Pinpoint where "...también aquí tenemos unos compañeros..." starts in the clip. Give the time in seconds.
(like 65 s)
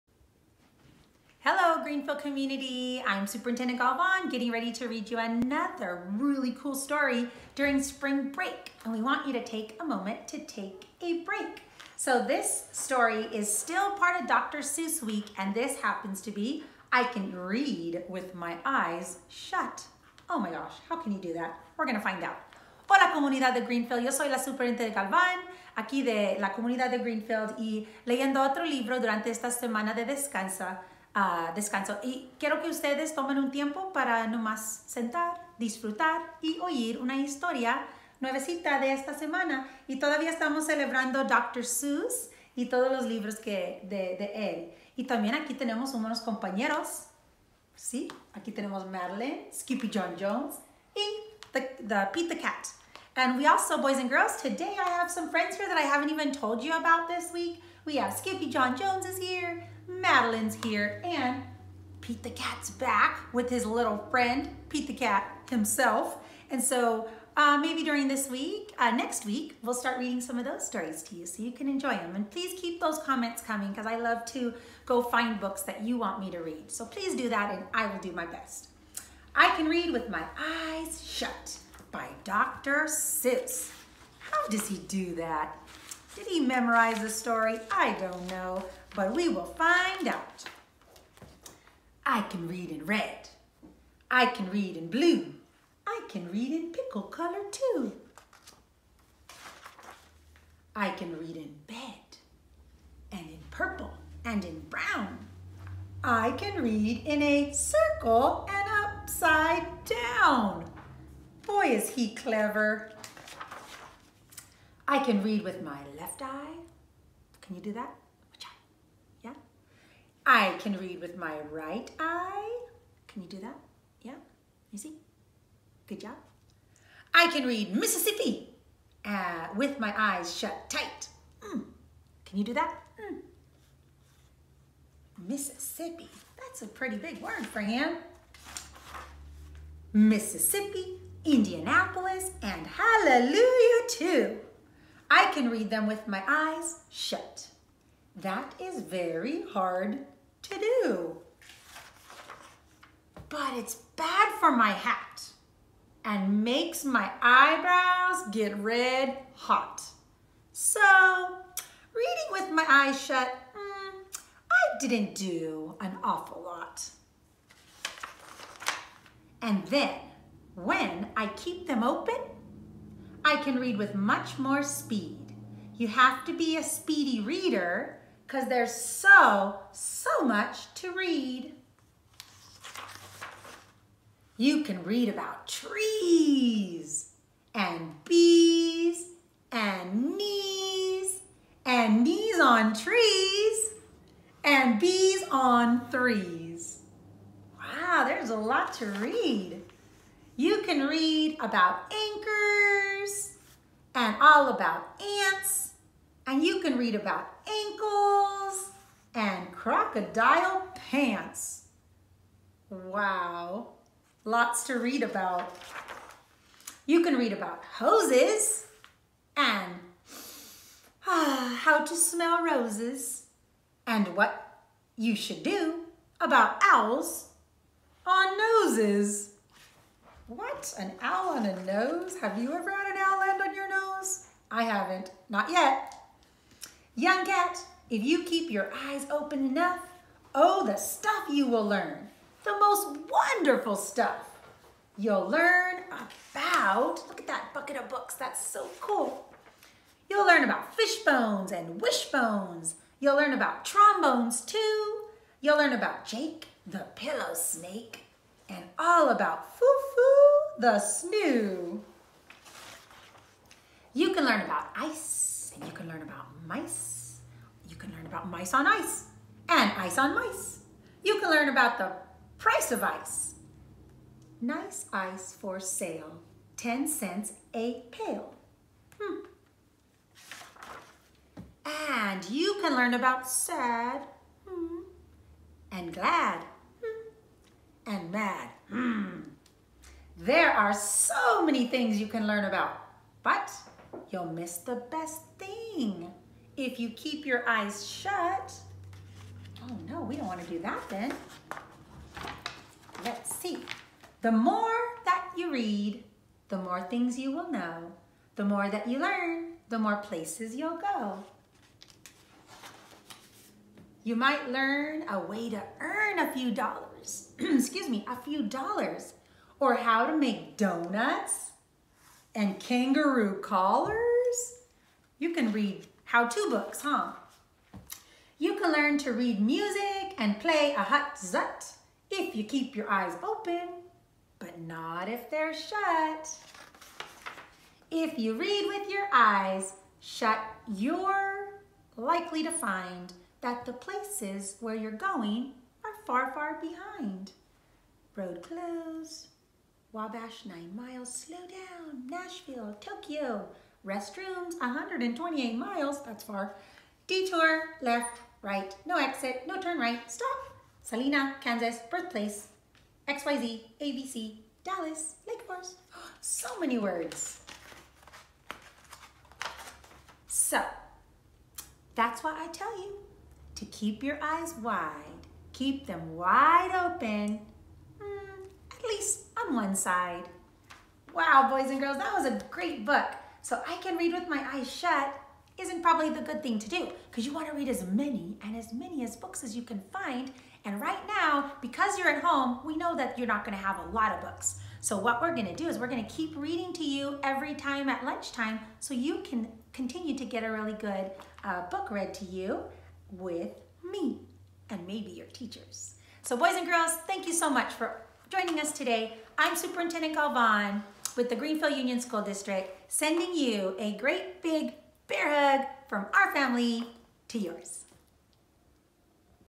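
45 s.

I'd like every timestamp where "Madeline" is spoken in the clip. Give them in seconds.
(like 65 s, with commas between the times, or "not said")
48 s, 59 s.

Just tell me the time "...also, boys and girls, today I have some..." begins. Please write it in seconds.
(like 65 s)
53 s.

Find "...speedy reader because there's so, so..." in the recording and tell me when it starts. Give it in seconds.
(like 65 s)
176 s.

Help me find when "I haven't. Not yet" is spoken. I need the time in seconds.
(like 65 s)
234 s.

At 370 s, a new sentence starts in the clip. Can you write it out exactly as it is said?
So, that's why I tell you to keep your eyes wide.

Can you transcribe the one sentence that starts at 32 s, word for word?
Y quiero que ustedes tomen un tiempo para no más sentar, disfrutar y oír una historia nuevecita de esta semana.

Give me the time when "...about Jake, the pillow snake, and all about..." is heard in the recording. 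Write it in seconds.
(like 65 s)
255 s.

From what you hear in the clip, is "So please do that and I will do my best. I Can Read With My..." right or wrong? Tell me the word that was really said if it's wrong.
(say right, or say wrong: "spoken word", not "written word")
right.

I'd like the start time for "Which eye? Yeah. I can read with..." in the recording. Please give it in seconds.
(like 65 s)
118 s.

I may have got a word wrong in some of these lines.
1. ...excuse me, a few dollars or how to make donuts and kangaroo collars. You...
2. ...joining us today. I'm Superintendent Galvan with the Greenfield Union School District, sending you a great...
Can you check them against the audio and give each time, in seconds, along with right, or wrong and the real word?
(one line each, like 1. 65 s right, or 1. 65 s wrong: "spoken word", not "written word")
1. 317 s right
2. 408 s right.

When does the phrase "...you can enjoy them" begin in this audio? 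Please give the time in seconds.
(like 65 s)
71 s.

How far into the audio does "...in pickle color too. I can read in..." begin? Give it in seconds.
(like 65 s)
96 s.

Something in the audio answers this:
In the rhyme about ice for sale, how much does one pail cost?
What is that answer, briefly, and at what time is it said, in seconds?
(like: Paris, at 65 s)
10 cents, at 276 s.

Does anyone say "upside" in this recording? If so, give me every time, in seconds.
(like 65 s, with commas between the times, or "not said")
108 s.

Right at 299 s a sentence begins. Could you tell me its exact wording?
Oh no, we don't want to do that then.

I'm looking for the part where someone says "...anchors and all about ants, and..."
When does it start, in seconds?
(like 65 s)
201 s.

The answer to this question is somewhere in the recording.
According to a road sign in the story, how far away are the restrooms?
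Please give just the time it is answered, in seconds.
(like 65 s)
354 s.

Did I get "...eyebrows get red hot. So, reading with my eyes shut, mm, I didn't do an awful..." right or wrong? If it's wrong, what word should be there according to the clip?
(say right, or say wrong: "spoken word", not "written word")
right.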